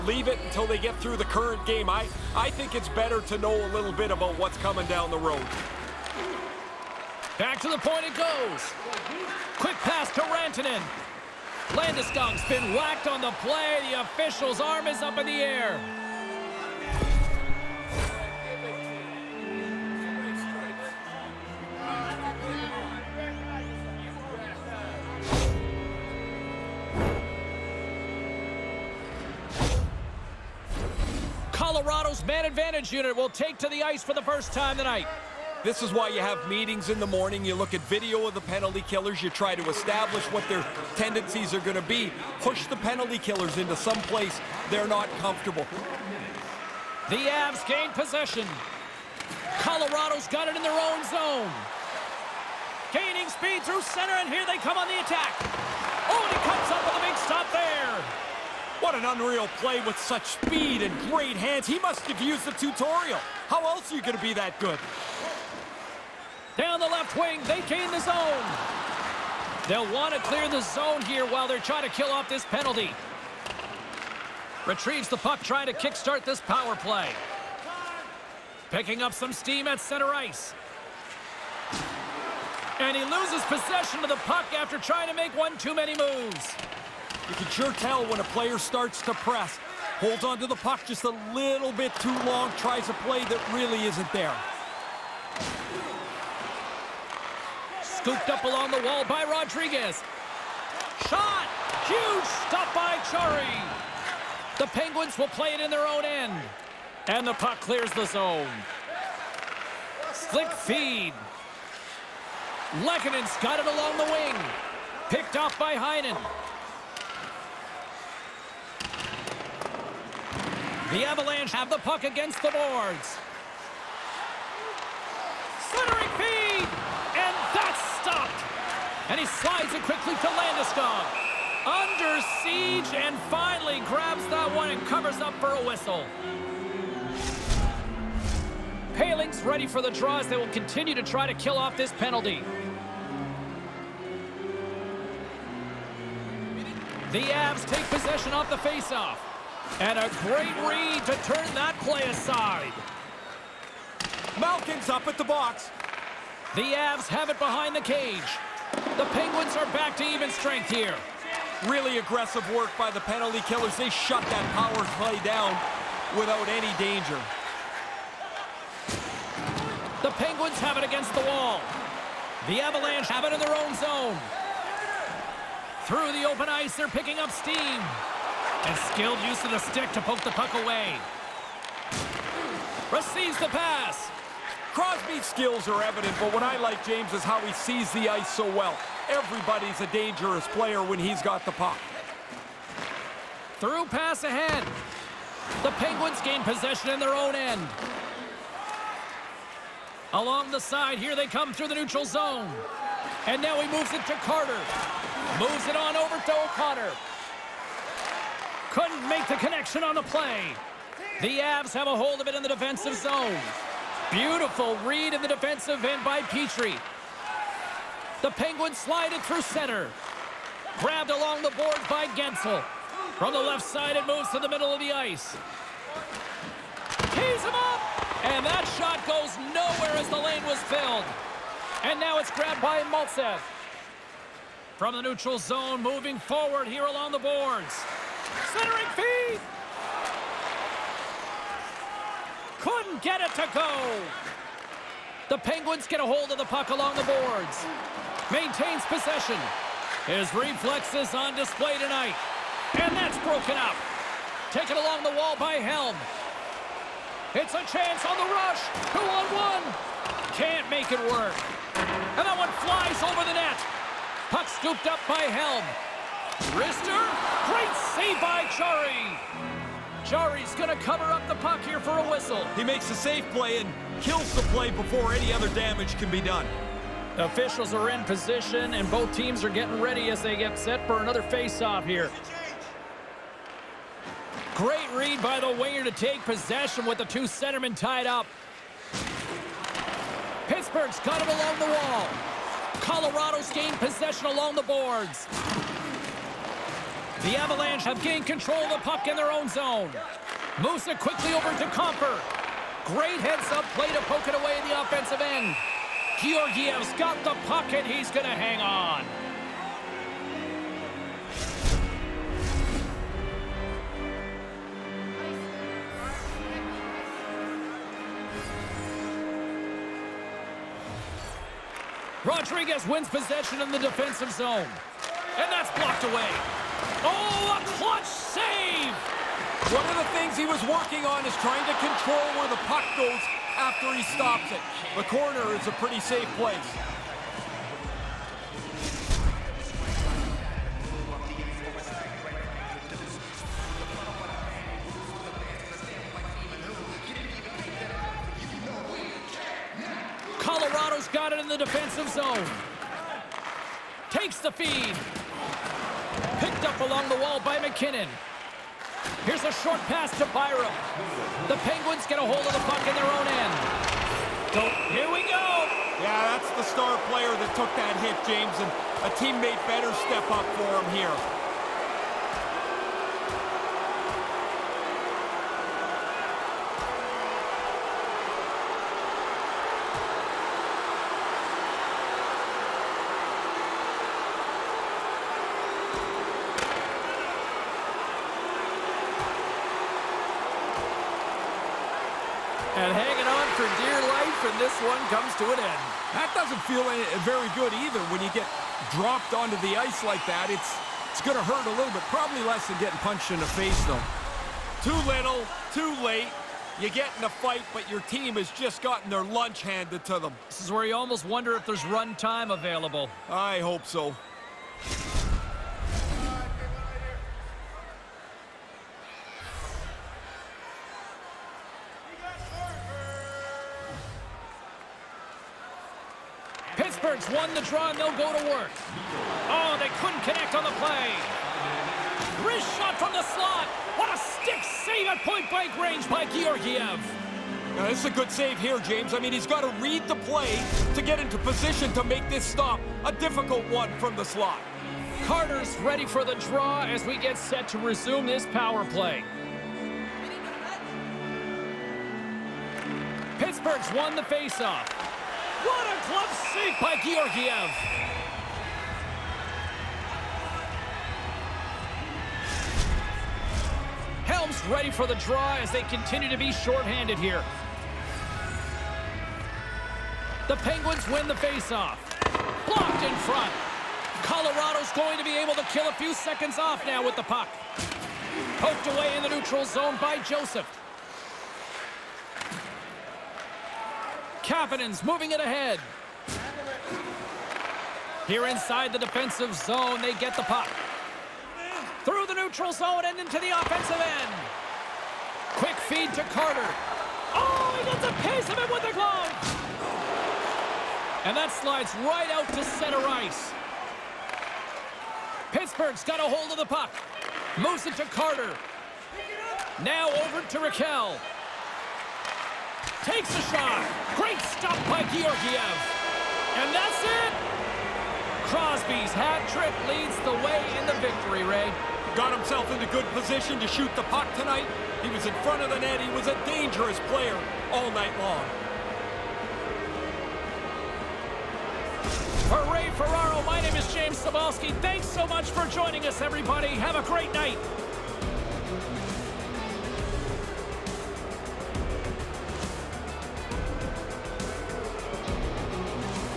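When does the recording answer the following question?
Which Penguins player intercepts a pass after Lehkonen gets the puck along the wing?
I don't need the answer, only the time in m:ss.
1:55.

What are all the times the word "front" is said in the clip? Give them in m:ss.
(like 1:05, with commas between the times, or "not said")
7:53, 8:45.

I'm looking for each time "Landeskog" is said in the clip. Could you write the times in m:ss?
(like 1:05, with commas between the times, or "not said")
0:11, 2:10.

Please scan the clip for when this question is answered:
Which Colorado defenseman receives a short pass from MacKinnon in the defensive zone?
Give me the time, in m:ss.
6:00.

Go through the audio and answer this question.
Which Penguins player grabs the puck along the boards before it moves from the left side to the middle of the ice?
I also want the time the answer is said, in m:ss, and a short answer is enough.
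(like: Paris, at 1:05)
Guentzel, at 3:42.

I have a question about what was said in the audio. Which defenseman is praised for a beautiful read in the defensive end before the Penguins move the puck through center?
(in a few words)
Petry.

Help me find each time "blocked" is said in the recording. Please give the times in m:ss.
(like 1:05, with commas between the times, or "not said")
5:25, 7:52.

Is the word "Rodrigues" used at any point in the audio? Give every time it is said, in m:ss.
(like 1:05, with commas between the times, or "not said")
1:39, 5:22.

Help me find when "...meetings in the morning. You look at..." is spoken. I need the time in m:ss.
0:36.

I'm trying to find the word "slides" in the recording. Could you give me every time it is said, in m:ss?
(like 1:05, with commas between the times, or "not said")
2:09, 3:38, 8:21.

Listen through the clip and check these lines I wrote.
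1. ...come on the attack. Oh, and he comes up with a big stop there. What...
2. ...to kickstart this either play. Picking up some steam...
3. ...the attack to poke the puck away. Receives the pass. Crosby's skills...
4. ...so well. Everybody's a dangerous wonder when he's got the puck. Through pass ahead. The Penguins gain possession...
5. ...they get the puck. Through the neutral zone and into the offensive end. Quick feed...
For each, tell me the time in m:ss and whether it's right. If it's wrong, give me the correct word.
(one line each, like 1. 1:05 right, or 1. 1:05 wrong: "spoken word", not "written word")
1. 0:54 right
2. 1:15 wrong: "power", not "either"
3. 2:59 wrong: "stick", not "attack"
4. 3:08 wrong: "player", not "wonder"
5. 8:10 right.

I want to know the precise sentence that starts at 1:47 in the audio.
And the puck clears the zone.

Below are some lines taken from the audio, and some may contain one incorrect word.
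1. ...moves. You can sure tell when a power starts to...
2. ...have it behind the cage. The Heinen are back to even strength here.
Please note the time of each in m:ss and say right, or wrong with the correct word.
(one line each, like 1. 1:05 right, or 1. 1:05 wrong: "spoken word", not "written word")
1. 1:25 wrong: "player", not "power"
2. 2:37 wrong: "Penguins", not "Heinen".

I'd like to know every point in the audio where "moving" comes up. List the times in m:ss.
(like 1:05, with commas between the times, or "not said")
3:55, 8:05.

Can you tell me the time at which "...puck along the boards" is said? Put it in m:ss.
4:06.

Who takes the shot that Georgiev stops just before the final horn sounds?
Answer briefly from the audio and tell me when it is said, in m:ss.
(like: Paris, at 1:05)
Rakell, at 8:30.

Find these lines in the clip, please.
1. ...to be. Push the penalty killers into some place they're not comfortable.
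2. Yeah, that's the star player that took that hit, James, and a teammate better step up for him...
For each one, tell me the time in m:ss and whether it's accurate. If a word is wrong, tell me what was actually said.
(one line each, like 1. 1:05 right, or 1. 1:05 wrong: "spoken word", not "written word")
1. 0:41 right
2. 6:06 right.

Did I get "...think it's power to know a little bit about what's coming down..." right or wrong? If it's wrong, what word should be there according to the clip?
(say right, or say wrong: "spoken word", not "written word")
wrong: "better", not "power".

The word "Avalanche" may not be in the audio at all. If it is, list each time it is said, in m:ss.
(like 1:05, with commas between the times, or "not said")
2:01, 2:52, 4:57.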